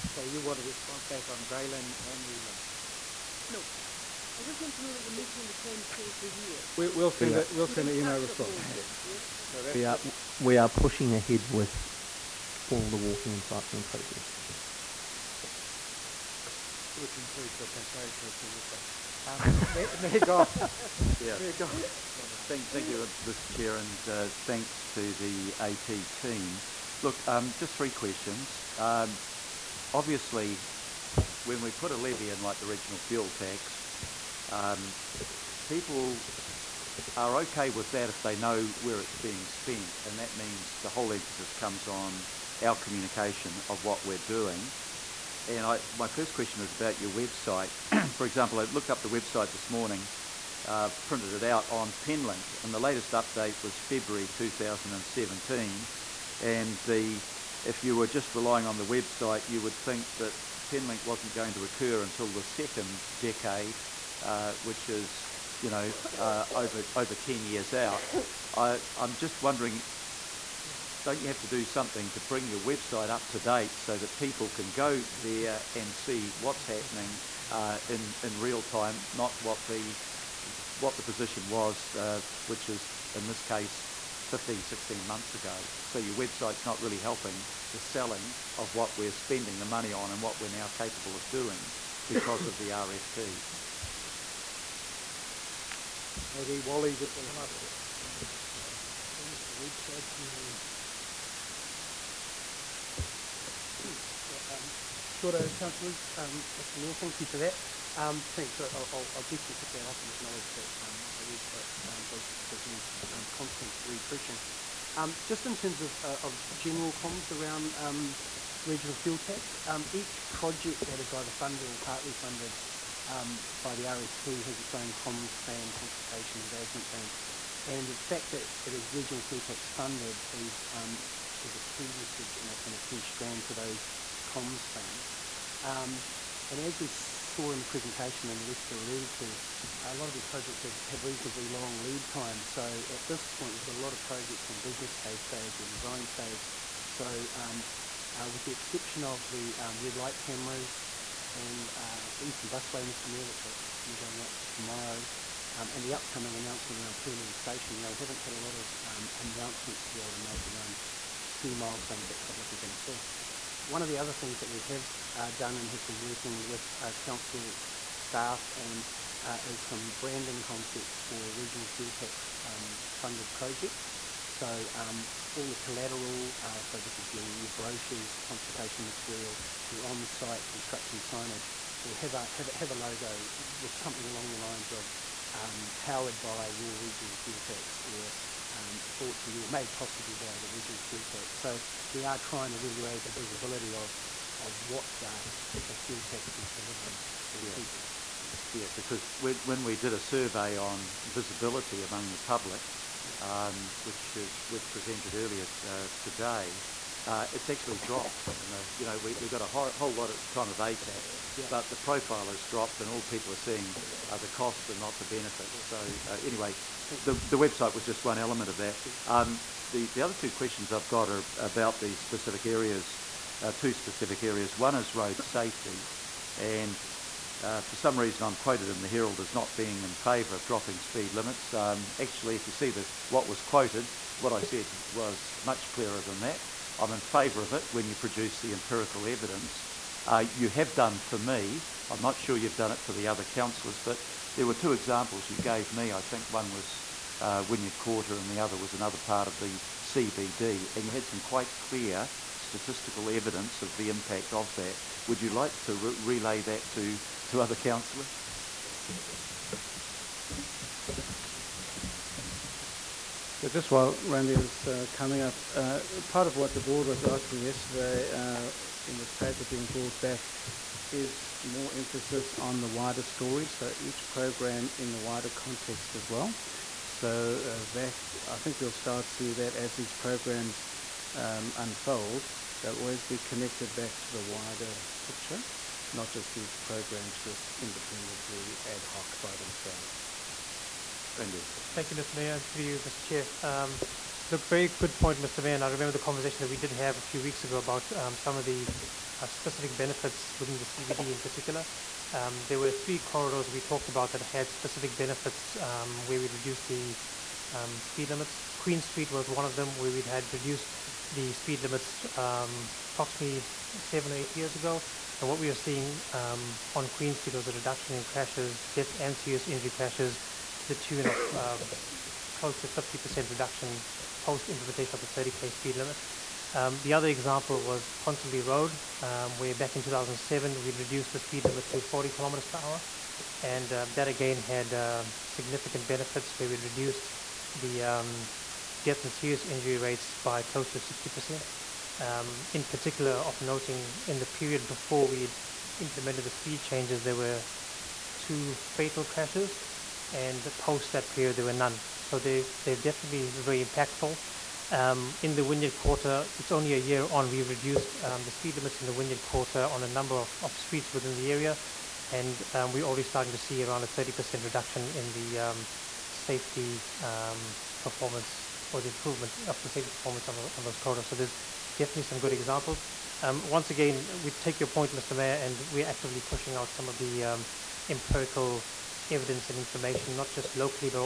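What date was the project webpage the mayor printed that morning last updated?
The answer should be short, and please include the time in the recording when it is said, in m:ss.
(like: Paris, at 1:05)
February 2017, at 0:53.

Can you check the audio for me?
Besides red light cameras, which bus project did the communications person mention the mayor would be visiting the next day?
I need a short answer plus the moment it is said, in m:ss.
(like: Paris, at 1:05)
Eastern Busway, at 2:32.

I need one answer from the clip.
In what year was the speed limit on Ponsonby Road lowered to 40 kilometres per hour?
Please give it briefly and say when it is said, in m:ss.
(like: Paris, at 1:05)
2007, at 5:29.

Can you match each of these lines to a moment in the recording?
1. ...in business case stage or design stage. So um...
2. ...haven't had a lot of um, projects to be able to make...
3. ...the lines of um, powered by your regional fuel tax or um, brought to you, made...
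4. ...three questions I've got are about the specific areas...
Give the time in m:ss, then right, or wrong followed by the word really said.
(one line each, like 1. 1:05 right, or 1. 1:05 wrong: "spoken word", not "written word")
1. 2:24 right
2. 2:37 wrong: "announcements", not "projects"
3. 3:04 right
4. 3:40 wrong: "two", not "three".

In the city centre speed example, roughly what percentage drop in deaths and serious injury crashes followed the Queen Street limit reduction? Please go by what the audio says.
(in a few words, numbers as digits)
50%.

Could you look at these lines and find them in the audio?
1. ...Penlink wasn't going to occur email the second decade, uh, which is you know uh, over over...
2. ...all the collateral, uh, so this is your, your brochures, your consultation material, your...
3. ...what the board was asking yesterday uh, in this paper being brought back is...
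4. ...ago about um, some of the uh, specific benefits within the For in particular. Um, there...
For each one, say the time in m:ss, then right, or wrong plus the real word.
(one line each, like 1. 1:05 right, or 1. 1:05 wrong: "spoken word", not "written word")
1. 1:00 wrong: "until", not "email"
2. 2:55 right
3. 4:26 right
4. 4:57 wrong: "CBD", not "For".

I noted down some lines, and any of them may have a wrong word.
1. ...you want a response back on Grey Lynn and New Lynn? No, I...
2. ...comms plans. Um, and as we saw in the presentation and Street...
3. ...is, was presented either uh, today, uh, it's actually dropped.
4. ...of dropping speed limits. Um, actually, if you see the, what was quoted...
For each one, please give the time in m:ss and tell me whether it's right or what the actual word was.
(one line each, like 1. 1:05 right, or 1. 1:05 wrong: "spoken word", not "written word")
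1. 0:00 right
2. 2:14 wrong: "Lester", not "Street"
3. 3:24 wrong: "earlier", not "either"
4. 3:50 right.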